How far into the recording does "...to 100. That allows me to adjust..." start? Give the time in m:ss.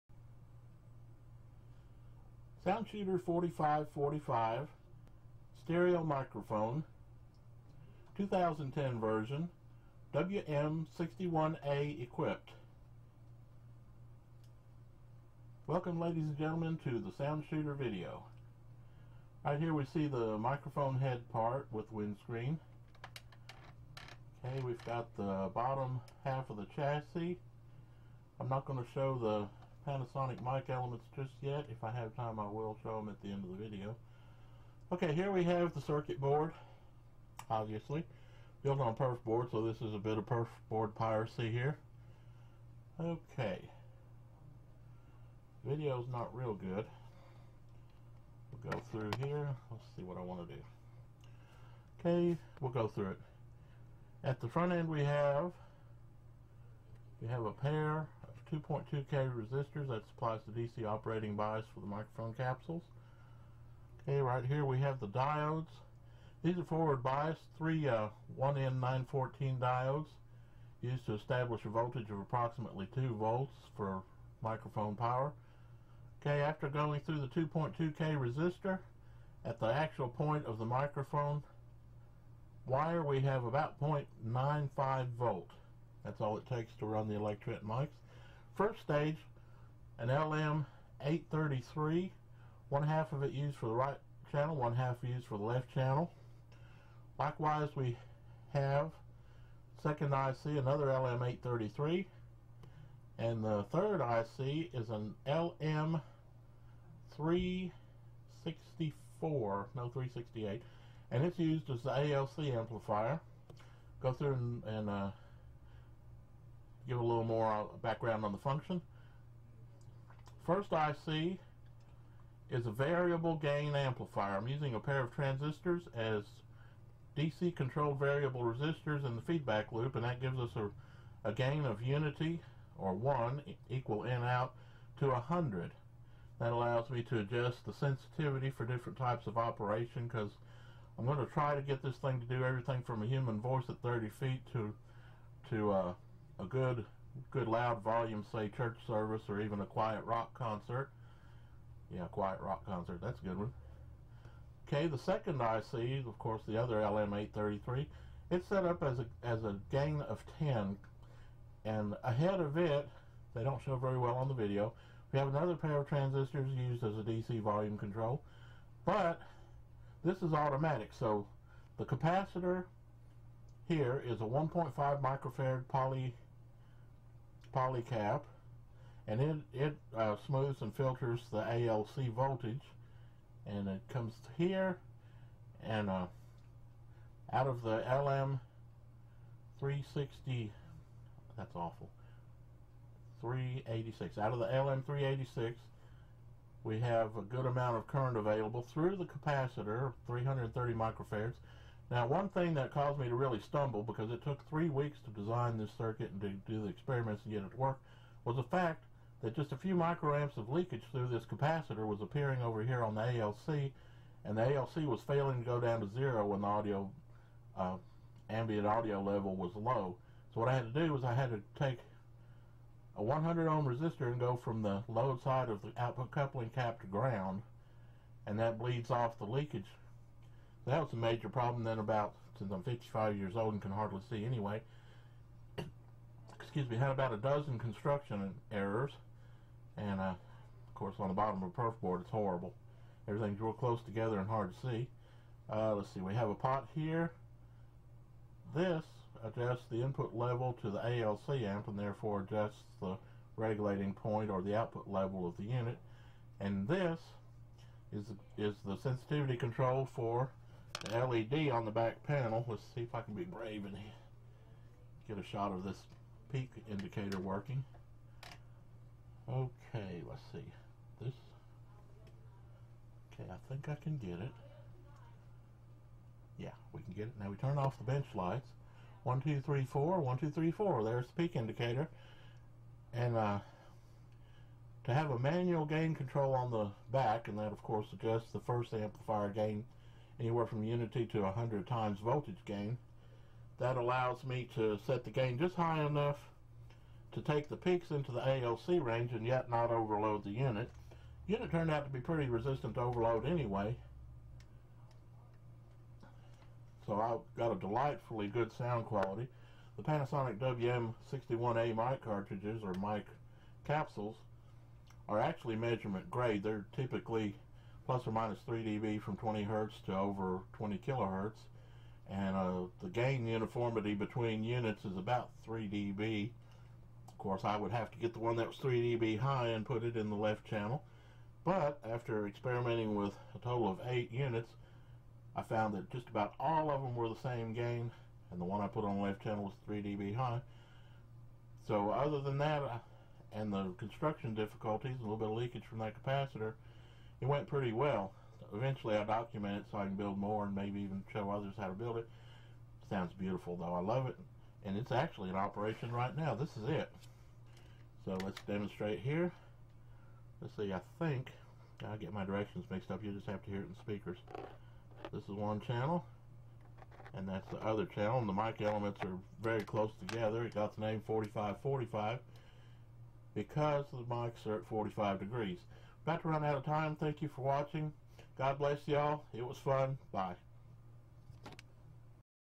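2:14.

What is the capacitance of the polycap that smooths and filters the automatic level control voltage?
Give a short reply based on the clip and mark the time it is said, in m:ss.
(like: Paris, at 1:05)
1.5 microfarad, at 2:54.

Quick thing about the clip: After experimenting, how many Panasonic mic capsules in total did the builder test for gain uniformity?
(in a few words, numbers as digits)
8.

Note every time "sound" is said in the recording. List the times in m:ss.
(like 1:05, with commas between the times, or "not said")
0:02, 0:17, 5:08, 5:52.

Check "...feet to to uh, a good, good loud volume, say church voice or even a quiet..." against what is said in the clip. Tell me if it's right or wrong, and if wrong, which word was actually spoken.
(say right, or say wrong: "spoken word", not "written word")
wrong: "service", not "voice".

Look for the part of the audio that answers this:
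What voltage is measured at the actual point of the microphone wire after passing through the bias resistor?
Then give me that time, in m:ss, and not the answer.
1:23.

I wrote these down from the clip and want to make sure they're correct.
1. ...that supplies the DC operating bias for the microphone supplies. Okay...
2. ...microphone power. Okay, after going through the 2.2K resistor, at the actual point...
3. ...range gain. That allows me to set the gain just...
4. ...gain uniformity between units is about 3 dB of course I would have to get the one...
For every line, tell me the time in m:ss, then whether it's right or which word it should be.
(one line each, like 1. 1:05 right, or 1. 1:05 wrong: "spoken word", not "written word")
1. 0:59 wrong: "capsules", not "supplies"
2. 1:14 right
3. 4:51 wrong: "voltage", not "range"
4. 5:22 right.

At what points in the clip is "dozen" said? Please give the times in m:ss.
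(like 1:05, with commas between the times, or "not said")
3:57.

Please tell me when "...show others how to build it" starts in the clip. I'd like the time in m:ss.
5:51.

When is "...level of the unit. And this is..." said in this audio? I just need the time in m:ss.
4:14.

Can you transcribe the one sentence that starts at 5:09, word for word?
The Panasonic WM61A mic cartridges or mic capsules are actually measurement grade.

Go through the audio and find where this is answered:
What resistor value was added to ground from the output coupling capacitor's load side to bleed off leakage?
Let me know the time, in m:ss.
3:43.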